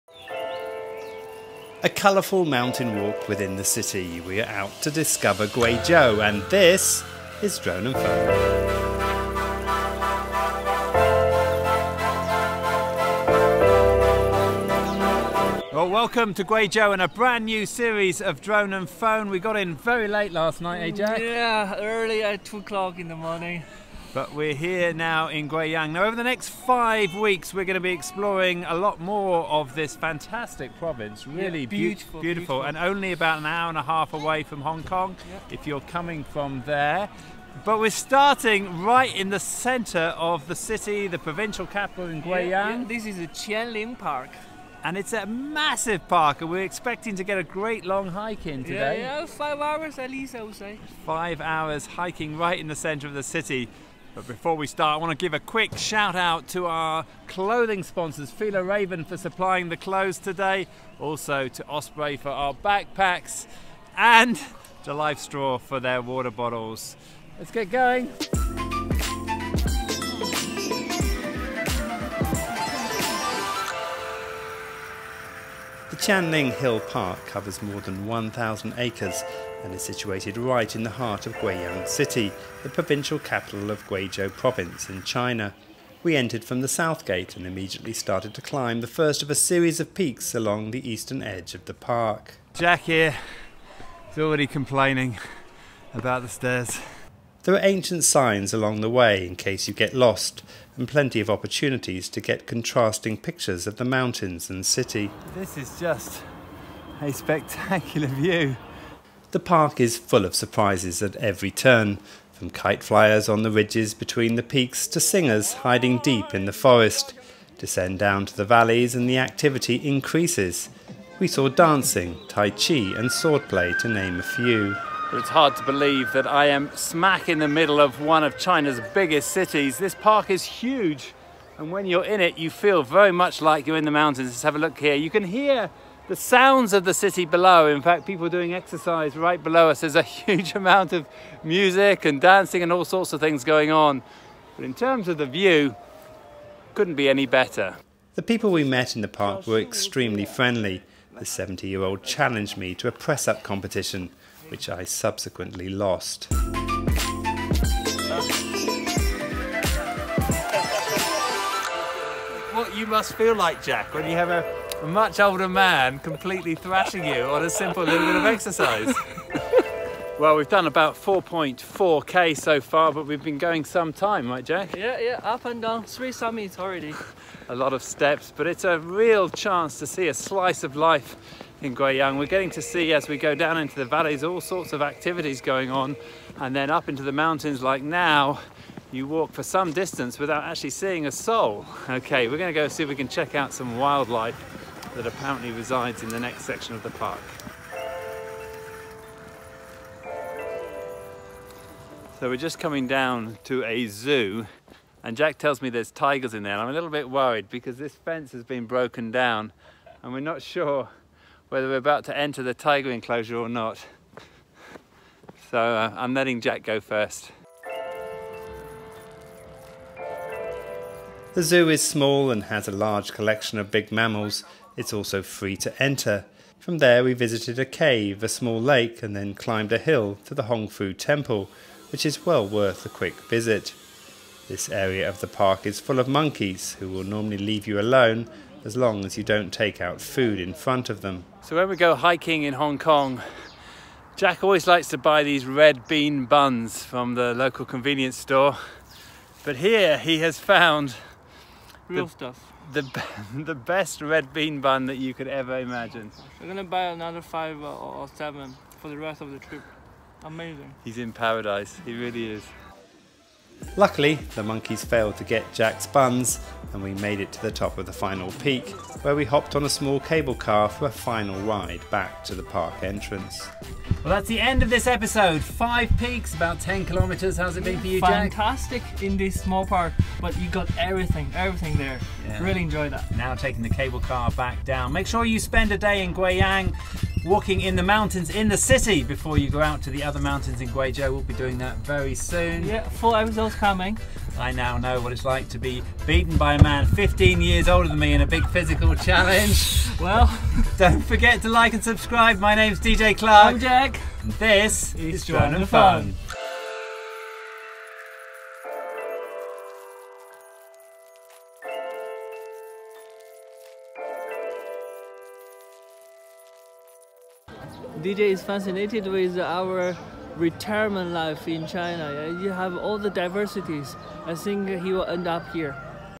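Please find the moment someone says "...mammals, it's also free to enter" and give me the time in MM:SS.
03:43.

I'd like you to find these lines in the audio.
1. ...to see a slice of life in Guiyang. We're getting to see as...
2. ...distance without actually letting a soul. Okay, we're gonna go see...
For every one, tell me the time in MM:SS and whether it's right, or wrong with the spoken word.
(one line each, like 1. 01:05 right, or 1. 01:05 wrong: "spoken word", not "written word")
1. 02:59 right
2. 03:09 wrong: "seeing", not "letting".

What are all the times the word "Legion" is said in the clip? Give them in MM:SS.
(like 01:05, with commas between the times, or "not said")
not said.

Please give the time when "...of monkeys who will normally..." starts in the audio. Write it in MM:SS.
03:55.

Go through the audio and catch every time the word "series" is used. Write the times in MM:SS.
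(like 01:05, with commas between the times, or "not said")
00:17, 01:29.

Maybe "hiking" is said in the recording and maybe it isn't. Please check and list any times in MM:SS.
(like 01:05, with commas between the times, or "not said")
00:51, 04:01.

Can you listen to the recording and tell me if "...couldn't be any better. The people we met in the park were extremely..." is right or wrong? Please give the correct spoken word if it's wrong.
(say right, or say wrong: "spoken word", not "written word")
right.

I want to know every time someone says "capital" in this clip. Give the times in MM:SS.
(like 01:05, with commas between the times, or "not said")
00:41, 01:23.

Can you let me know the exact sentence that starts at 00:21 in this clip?
Yeah, early at two o'clock in the morning.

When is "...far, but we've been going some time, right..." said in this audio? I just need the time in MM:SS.
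02:52.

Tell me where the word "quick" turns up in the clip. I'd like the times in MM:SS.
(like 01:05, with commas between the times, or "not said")
00:55, 03:52.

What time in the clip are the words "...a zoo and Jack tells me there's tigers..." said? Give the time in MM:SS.
03:23.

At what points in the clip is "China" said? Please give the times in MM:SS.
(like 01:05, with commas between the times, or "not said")
01:25, 02:08, 05:21.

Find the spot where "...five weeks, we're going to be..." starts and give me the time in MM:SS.
00:26.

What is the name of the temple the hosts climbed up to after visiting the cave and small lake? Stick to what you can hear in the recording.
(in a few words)
Hongfu Temple.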